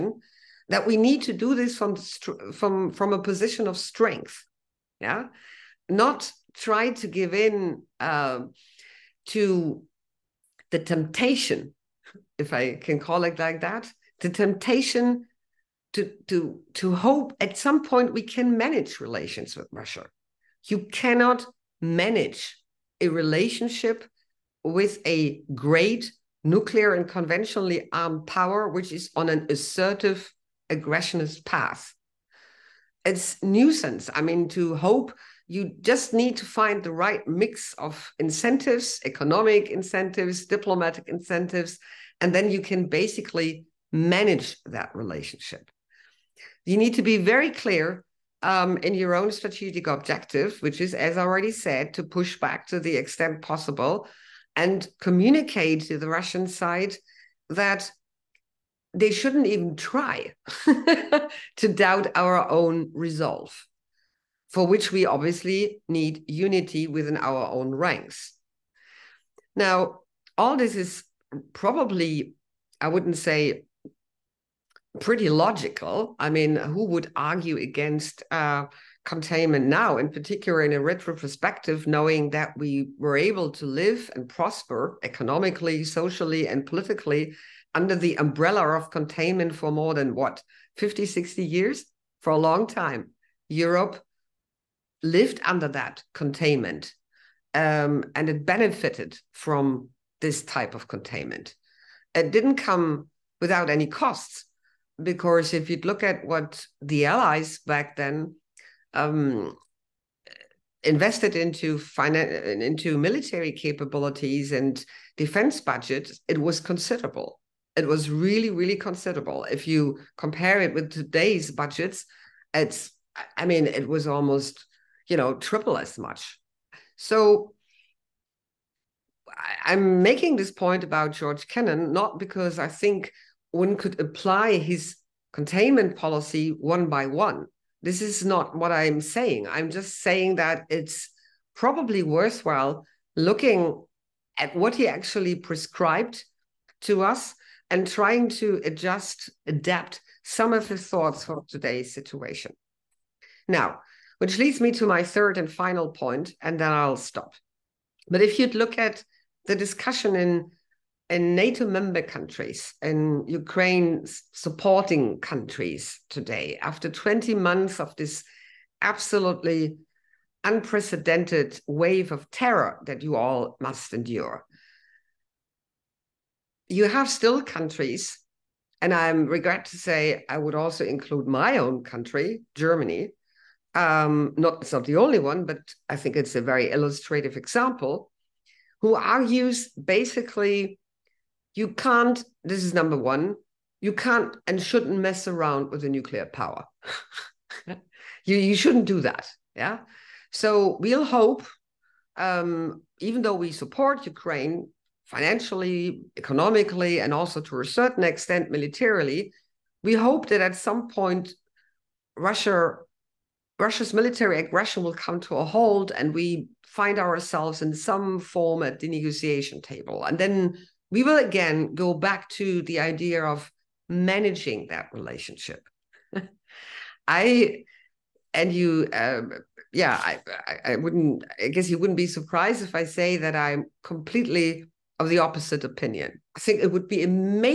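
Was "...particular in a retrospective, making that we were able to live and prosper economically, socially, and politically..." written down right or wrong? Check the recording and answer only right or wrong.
wrong.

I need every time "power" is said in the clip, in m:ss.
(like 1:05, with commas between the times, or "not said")
0:28, 3:16.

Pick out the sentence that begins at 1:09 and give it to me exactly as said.
Now, all this is probably, I wouldn't say pretty logical.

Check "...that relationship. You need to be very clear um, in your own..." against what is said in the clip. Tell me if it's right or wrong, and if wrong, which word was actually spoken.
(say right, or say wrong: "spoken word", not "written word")
right.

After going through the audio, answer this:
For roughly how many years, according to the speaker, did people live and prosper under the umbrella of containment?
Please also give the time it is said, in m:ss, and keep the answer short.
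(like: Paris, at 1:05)
50, 60 years, at 1:30.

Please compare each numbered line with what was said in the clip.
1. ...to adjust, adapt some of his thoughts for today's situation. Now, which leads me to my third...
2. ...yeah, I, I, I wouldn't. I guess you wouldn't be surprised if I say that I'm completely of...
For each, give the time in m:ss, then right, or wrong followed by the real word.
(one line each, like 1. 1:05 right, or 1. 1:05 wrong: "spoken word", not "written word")
1. 2:28 right
2. 3:49 right.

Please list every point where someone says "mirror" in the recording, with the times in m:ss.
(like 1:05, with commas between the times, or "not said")
not said.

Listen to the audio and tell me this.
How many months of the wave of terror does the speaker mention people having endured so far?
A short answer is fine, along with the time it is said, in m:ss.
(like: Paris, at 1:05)
20 months, at 2:46.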